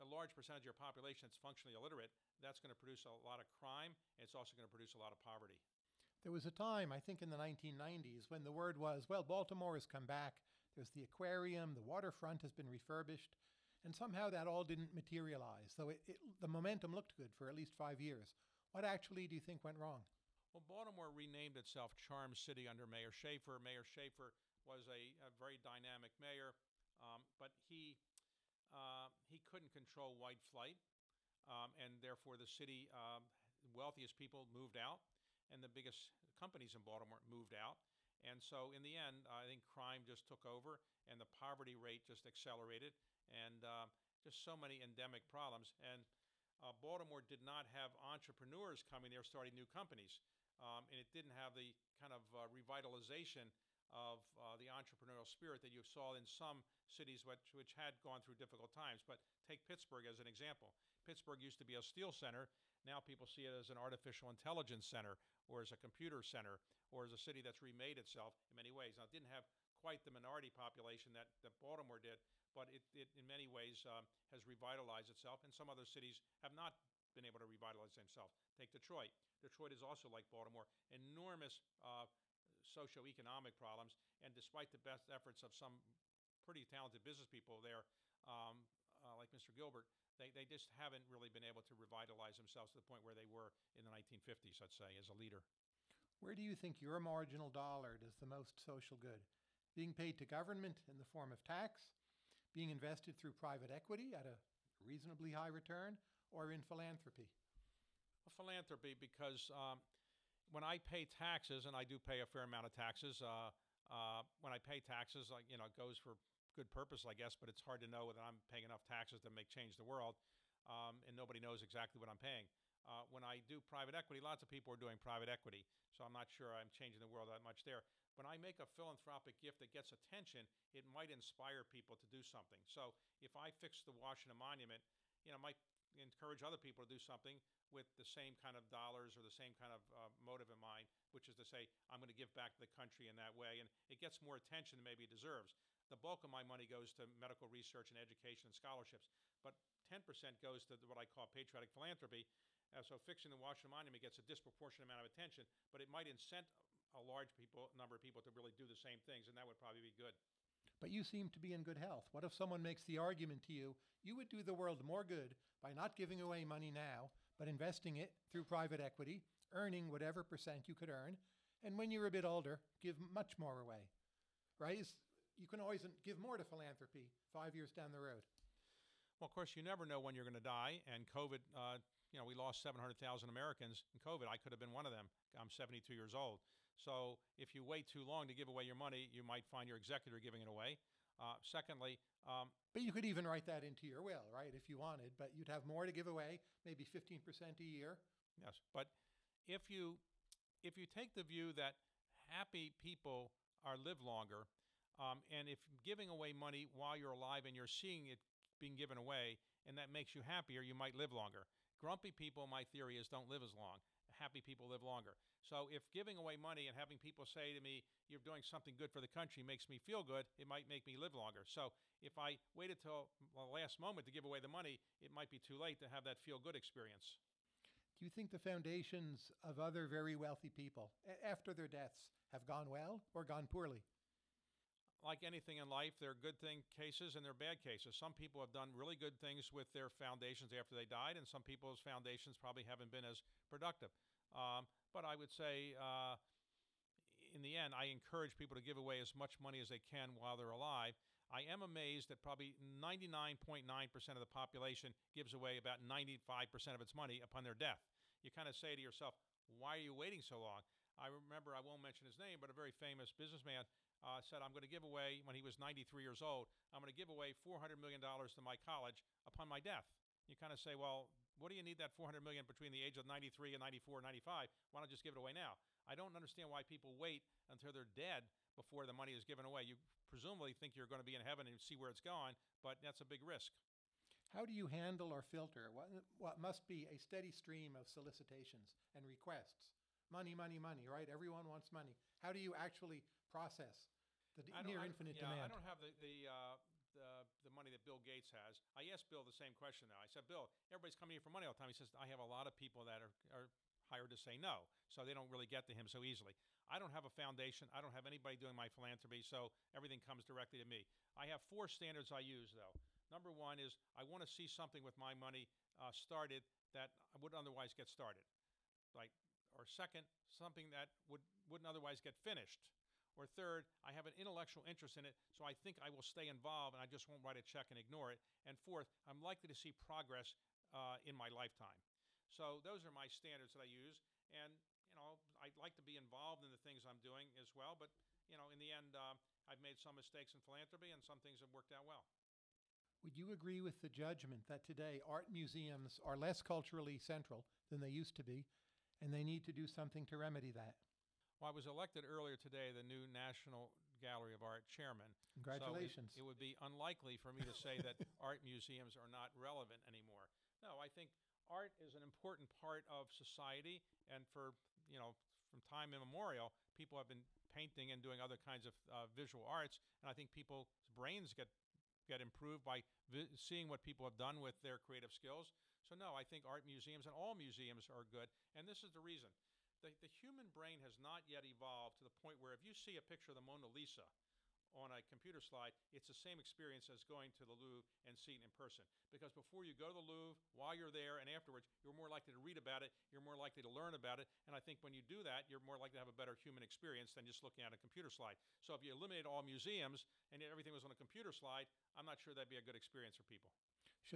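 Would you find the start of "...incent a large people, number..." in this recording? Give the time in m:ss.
2:36.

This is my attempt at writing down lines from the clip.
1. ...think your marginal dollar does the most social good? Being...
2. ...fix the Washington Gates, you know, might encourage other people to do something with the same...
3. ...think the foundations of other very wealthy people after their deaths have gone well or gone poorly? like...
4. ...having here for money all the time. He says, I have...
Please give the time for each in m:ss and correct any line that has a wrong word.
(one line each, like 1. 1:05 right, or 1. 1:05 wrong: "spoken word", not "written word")
1. 1:36 right
2. 2:13 wrong: "Monument", not "Gates"
3. 3:48 right
4. 5:00 wrong: "coming", not "having".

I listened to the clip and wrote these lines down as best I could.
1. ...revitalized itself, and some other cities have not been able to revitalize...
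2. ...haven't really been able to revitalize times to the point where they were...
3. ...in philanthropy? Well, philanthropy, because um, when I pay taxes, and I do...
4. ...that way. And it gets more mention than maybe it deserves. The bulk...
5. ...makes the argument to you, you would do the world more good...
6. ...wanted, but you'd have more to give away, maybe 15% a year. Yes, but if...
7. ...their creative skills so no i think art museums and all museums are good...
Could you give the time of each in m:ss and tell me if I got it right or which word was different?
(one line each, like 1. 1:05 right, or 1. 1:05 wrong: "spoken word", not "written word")
1. 1:14 right
2. 1:30 wrong: "themselves", not "times"
3. 1:46 right
4. 2:23 wrong: "attention", not "mention"
5. 2:42 right
6. 3:14 right
7. 6:14 right.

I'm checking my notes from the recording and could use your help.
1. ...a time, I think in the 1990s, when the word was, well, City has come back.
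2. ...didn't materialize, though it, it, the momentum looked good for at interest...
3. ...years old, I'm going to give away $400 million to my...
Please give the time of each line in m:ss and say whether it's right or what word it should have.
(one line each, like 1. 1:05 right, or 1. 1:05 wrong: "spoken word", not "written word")
1. 0:06 wrong: "Baltimore", not "City"
2. 0:14 wrong: "least", not "interest"
3. 4:26 right.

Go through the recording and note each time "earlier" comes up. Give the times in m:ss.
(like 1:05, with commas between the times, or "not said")
5:52.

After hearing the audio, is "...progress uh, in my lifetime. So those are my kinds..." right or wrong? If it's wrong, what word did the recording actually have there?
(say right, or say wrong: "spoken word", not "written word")
wrong: "standards", not "kinds".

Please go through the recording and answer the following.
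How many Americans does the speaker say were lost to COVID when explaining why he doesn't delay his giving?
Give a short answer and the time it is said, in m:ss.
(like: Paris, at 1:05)
700,000, at 3:02.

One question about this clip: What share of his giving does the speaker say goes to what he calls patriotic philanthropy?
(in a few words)
10%.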